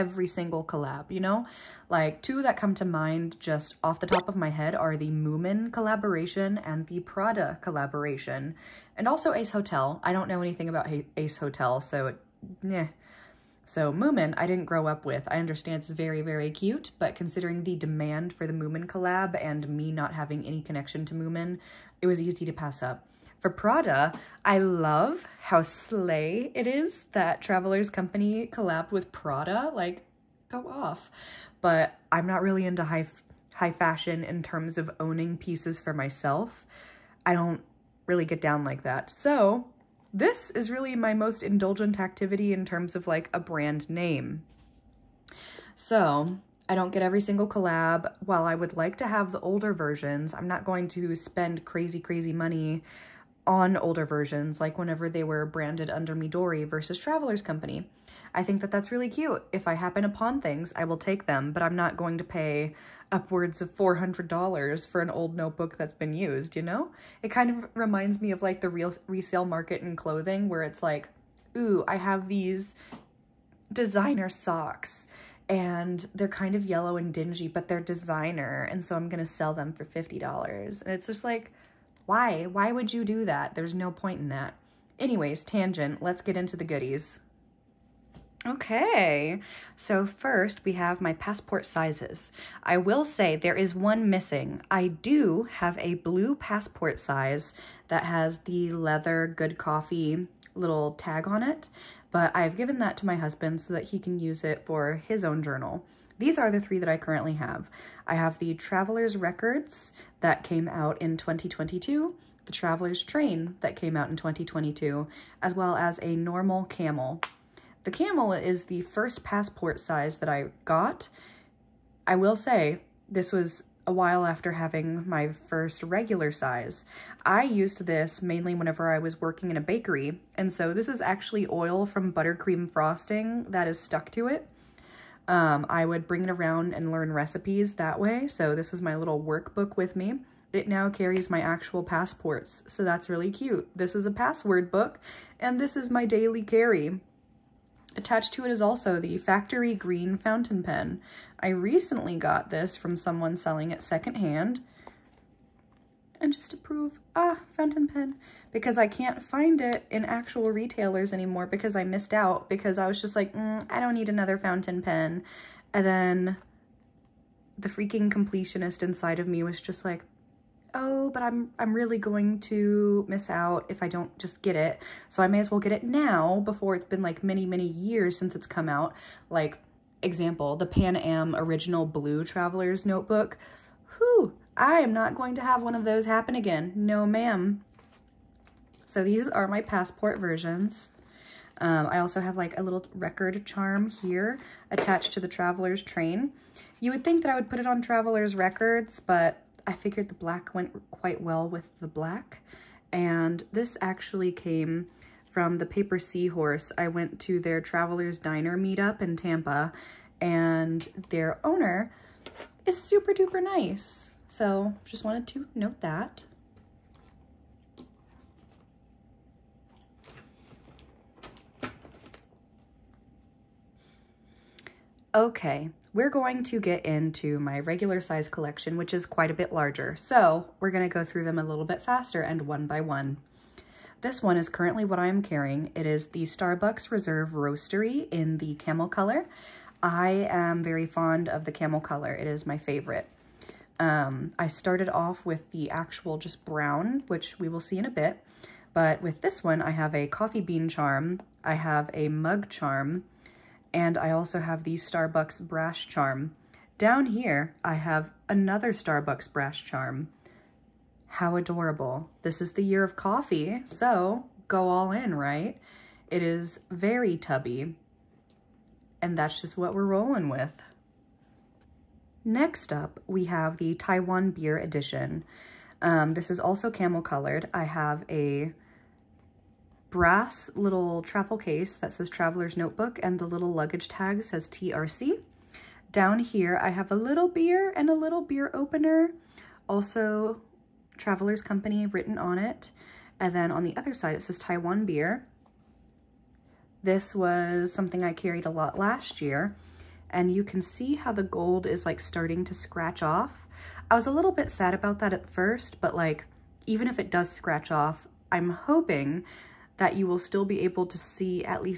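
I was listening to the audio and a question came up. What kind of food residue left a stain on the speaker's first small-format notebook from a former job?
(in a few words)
buttercream frosting.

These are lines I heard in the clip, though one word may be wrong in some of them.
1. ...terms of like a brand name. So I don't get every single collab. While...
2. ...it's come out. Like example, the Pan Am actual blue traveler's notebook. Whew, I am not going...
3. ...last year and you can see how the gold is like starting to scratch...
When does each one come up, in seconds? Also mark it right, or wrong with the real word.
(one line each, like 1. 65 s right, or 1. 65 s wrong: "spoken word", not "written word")
1. 42 s right
2. 178 s wrong: "original", not "actual"
3. 298 s right.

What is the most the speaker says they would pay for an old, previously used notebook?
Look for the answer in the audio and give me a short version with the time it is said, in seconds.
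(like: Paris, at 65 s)
$400, at 63 s.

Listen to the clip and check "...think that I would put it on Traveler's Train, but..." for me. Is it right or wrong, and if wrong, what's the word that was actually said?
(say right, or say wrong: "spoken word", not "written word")
wrong: "Records", not "Train".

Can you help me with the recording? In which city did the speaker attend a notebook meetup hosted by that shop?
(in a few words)
Tampa.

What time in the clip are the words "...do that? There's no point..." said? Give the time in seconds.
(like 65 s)
83 s.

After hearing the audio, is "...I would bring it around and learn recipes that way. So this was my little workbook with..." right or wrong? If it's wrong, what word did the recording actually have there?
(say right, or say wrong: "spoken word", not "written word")
right.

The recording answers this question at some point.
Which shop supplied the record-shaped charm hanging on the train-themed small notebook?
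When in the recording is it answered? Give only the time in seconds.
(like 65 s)
205 s.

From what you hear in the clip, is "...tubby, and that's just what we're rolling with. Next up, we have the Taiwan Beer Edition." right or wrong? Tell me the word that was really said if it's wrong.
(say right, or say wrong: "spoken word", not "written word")
right.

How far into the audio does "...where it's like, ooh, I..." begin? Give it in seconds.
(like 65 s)
70 s.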